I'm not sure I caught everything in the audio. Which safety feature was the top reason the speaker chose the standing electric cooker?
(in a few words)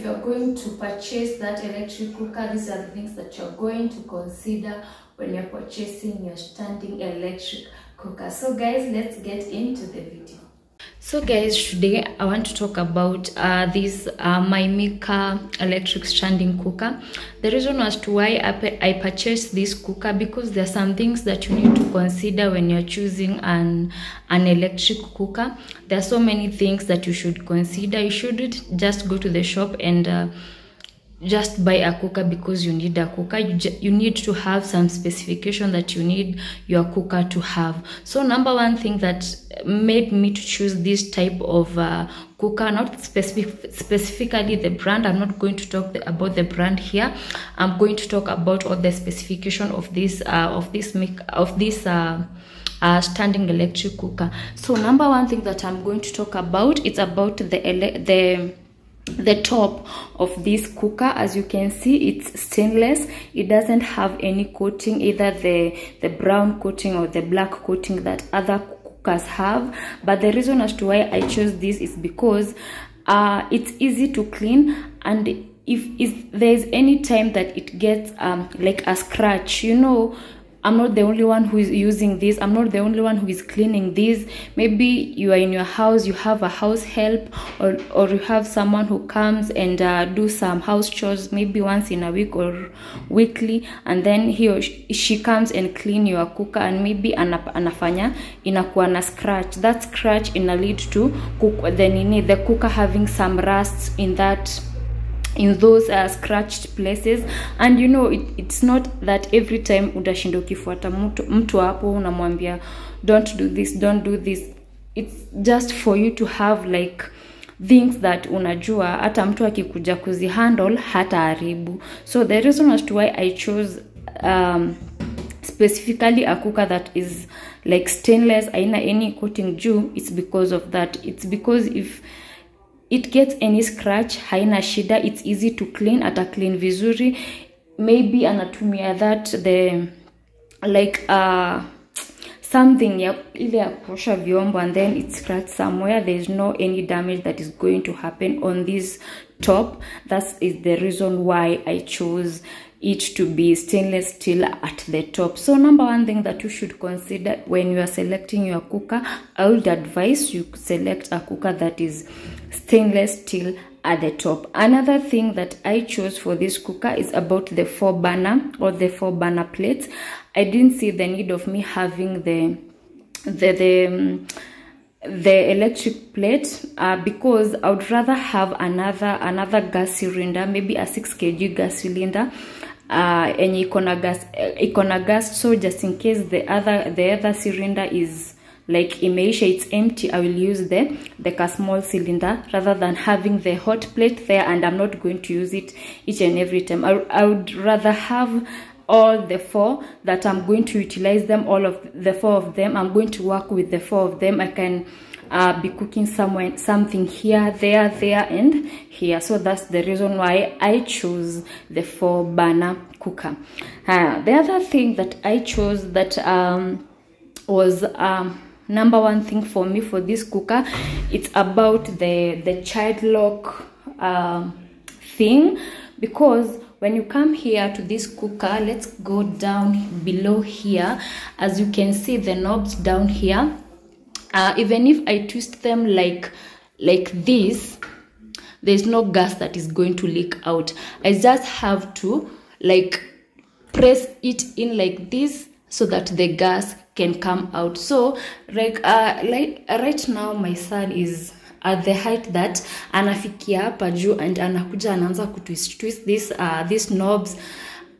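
child lock.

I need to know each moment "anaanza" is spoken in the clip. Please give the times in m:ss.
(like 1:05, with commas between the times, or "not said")
4:14.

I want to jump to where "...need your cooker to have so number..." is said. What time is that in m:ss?
0:36.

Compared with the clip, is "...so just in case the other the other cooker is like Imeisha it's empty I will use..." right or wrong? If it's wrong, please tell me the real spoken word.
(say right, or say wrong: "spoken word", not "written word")
wrong: "cylinder", not "cooker".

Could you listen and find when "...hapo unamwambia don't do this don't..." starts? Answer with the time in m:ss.
1:51.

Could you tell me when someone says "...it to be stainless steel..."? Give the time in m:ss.
2:32.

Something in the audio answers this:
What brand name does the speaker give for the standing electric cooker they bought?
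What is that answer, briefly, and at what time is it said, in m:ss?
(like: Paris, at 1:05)
Mika, at 0:14.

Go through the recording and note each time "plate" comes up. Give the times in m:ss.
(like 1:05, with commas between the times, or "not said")
2:49, 2:56, 3:13.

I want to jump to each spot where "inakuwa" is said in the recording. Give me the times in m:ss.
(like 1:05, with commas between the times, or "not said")
1:38.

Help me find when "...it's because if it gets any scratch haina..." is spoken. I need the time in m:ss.
2:11.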